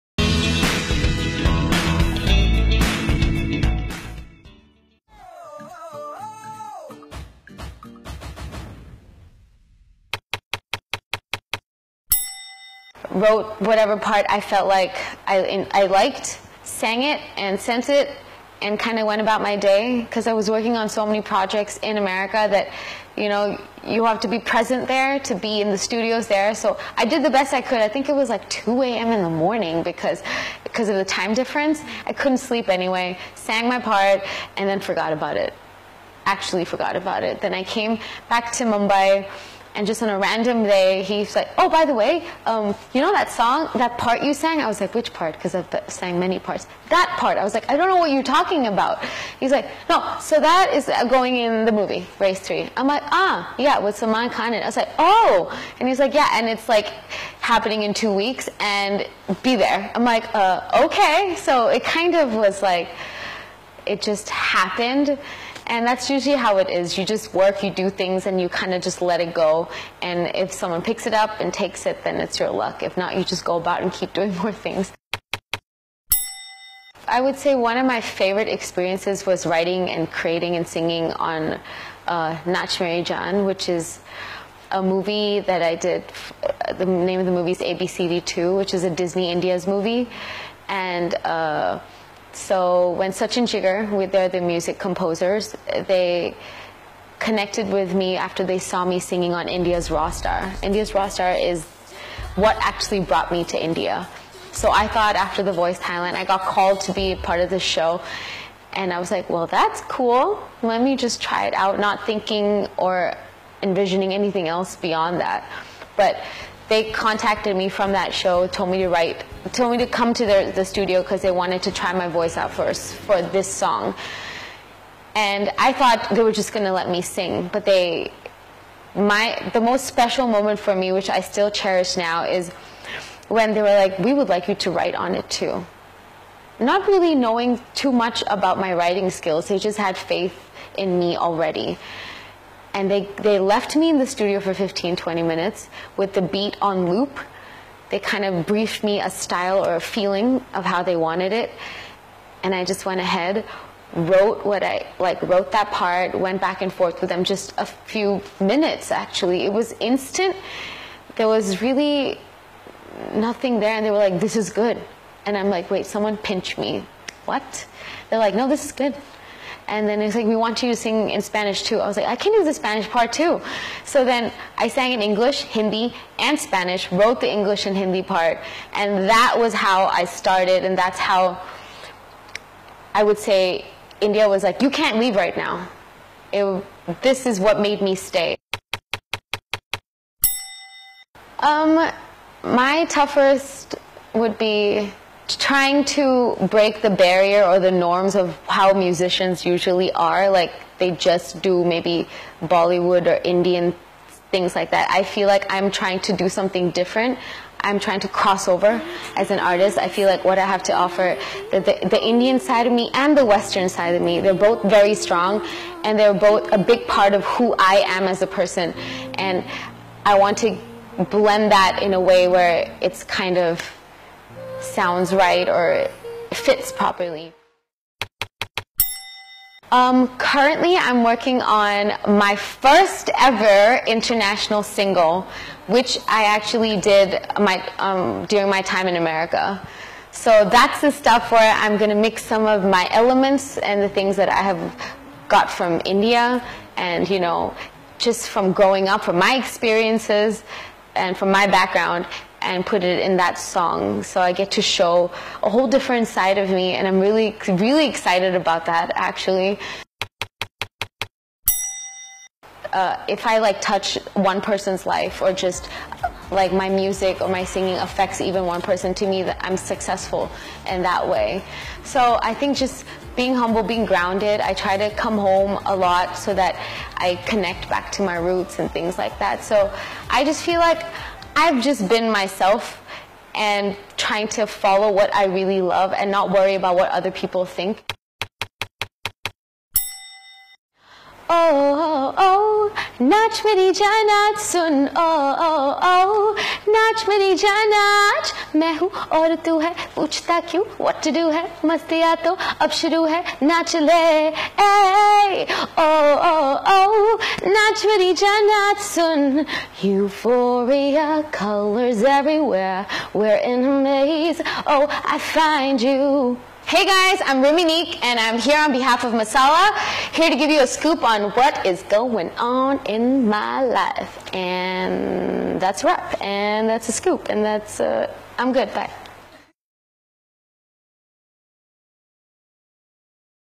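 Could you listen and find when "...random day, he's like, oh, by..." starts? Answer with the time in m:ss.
0:40.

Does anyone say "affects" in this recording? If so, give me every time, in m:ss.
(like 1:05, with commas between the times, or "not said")
4:27.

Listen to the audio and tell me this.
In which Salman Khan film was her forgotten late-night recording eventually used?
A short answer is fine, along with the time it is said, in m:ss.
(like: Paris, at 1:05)
Race 3, at 0:52.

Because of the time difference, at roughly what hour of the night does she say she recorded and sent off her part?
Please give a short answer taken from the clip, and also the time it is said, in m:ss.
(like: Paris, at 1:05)
2 a.m., at 0:28.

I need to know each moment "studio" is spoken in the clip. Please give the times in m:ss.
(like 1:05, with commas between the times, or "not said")
0:25, 2:00, 2:24.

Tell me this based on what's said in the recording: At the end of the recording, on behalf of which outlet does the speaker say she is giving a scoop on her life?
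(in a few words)
Masala.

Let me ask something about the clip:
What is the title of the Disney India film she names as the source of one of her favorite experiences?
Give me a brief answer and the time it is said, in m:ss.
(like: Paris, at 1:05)
ABCD2, at 1:27.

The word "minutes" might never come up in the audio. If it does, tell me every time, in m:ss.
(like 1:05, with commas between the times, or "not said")
2:25, 2:38.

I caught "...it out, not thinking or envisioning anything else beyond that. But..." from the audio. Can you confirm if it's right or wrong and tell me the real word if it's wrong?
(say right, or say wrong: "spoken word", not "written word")
right.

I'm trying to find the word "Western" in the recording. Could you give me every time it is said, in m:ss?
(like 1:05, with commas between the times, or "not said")
3:33.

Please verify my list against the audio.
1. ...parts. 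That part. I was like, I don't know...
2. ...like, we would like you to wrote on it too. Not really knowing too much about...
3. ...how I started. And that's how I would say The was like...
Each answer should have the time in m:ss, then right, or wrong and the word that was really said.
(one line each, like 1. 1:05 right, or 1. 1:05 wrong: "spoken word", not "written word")
1. 0:46 right
2. 2:13 wrong: "write", not "wrote"
3. 2:59 wrong: "India", not "The".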